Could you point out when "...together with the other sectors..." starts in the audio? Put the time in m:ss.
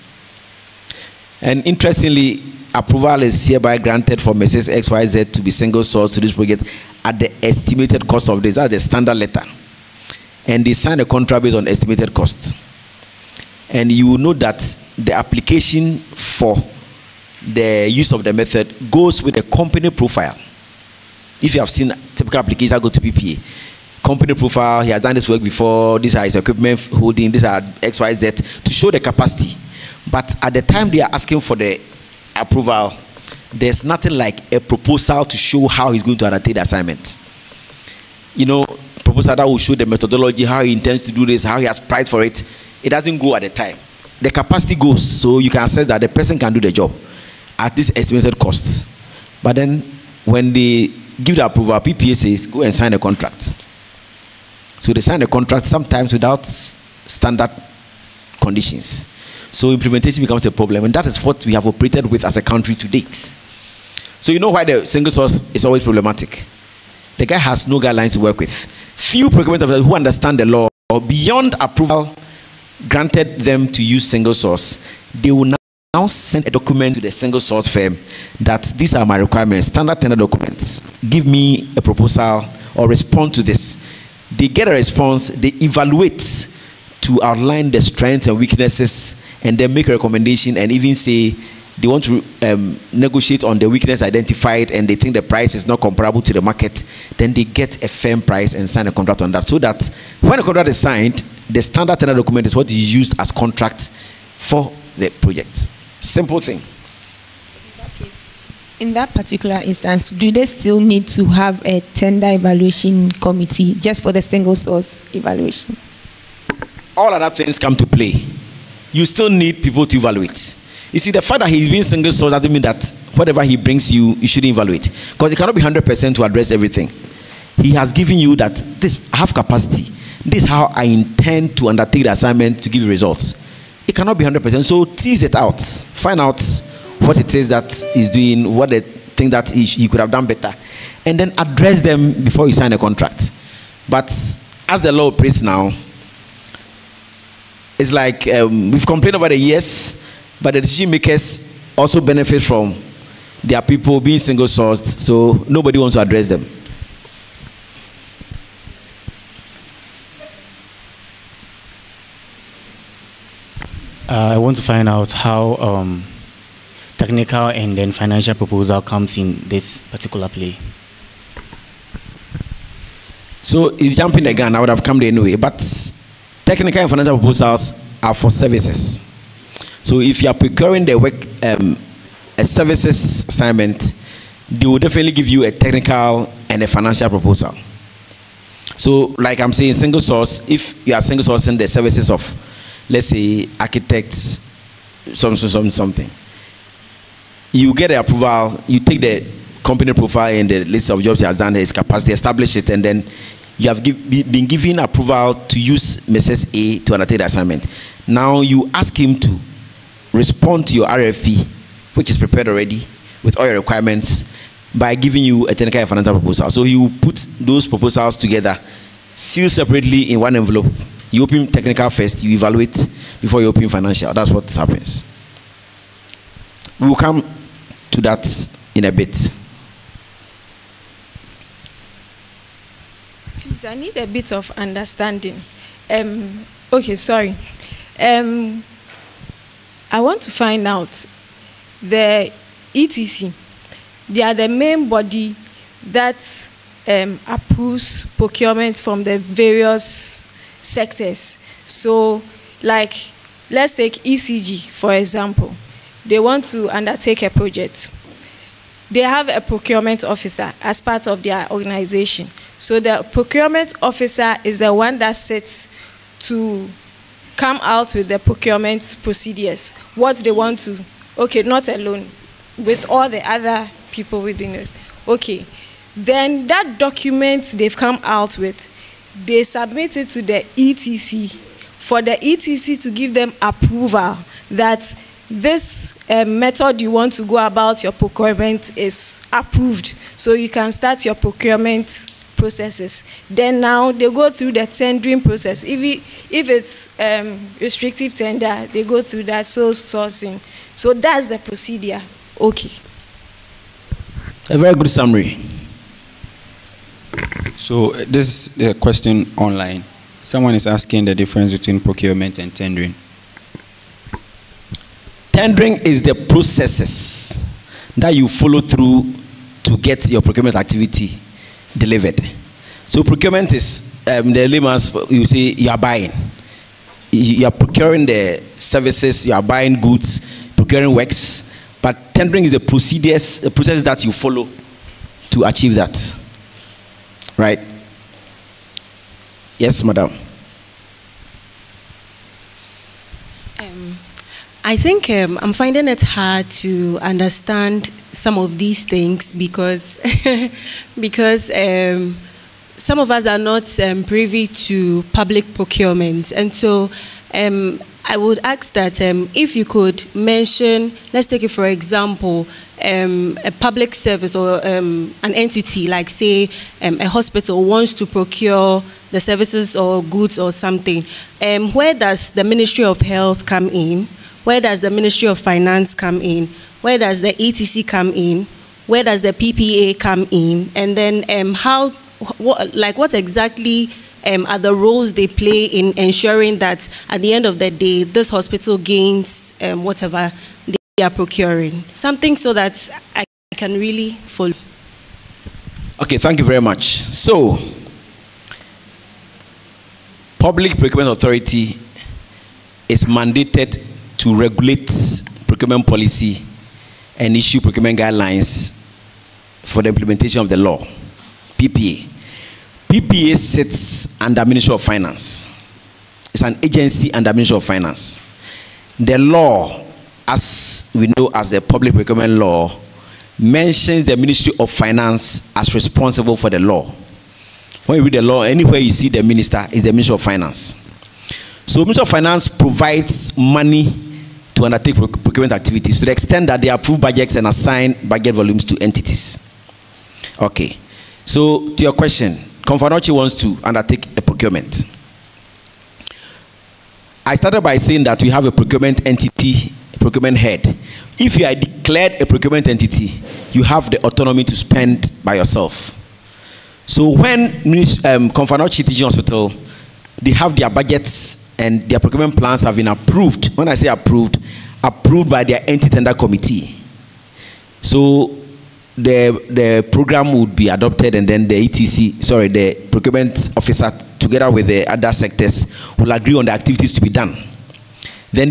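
7:54.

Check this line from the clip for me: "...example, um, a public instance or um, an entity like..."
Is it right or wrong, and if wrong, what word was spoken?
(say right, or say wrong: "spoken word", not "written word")
wrong: "service", not "instance".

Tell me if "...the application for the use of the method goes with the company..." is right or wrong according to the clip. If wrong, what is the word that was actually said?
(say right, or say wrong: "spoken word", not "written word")
right.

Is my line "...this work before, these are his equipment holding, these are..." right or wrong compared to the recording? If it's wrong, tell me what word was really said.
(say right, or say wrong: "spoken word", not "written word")
right.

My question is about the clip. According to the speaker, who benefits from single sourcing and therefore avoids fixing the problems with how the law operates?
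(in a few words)
The decision makers.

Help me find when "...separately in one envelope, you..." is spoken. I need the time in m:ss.
3:39.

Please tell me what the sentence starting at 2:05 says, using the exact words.
Because it cannot be 100% to address everything.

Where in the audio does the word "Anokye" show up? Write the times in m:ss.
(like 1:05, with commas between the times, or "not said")
7:22, 7:38.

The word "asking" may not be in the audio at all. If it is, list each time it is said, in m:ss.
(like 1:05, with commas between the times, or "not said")
0:31, 5:10.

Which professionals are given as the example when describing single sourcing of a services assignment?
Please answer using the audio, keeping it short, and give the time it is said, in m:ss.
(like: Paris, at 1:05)
Architects, at 3:13.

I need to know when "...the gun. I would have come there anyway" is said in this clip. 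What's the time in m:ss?
2:54.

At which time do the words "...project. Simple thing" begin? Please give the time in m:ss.
1:45.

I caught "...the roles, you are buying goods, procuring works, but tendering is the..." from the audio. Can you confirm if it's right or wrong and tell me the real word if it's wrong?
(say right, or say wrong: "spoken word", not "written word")
wrong: "services", not "roles".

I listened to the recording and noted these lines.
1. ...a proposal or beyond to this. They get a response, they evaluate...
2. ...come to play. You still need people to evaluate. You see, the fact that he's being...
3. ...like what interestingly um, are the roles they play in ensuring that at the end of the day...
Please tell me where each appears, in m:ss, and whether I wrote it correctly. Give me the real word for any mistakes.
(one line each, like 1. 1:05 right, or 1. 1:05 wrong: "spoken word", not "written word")
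1. 1:21 wrong: "respond", not "beyond"
2. 1:57 right
3. 6:22 wrong: "exactly", not "interestingly".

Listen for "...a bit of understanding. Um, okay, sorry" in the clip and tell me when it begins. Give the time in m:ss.
3:53.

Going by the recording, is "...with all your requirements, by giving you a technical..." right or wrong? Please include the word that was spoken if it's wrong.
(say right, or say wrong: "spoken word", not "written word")
right.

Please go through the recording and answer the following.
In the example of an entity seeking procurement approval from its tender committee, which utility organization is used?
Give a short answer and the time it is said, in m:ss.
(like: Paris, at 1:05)
ECG, at 4:14.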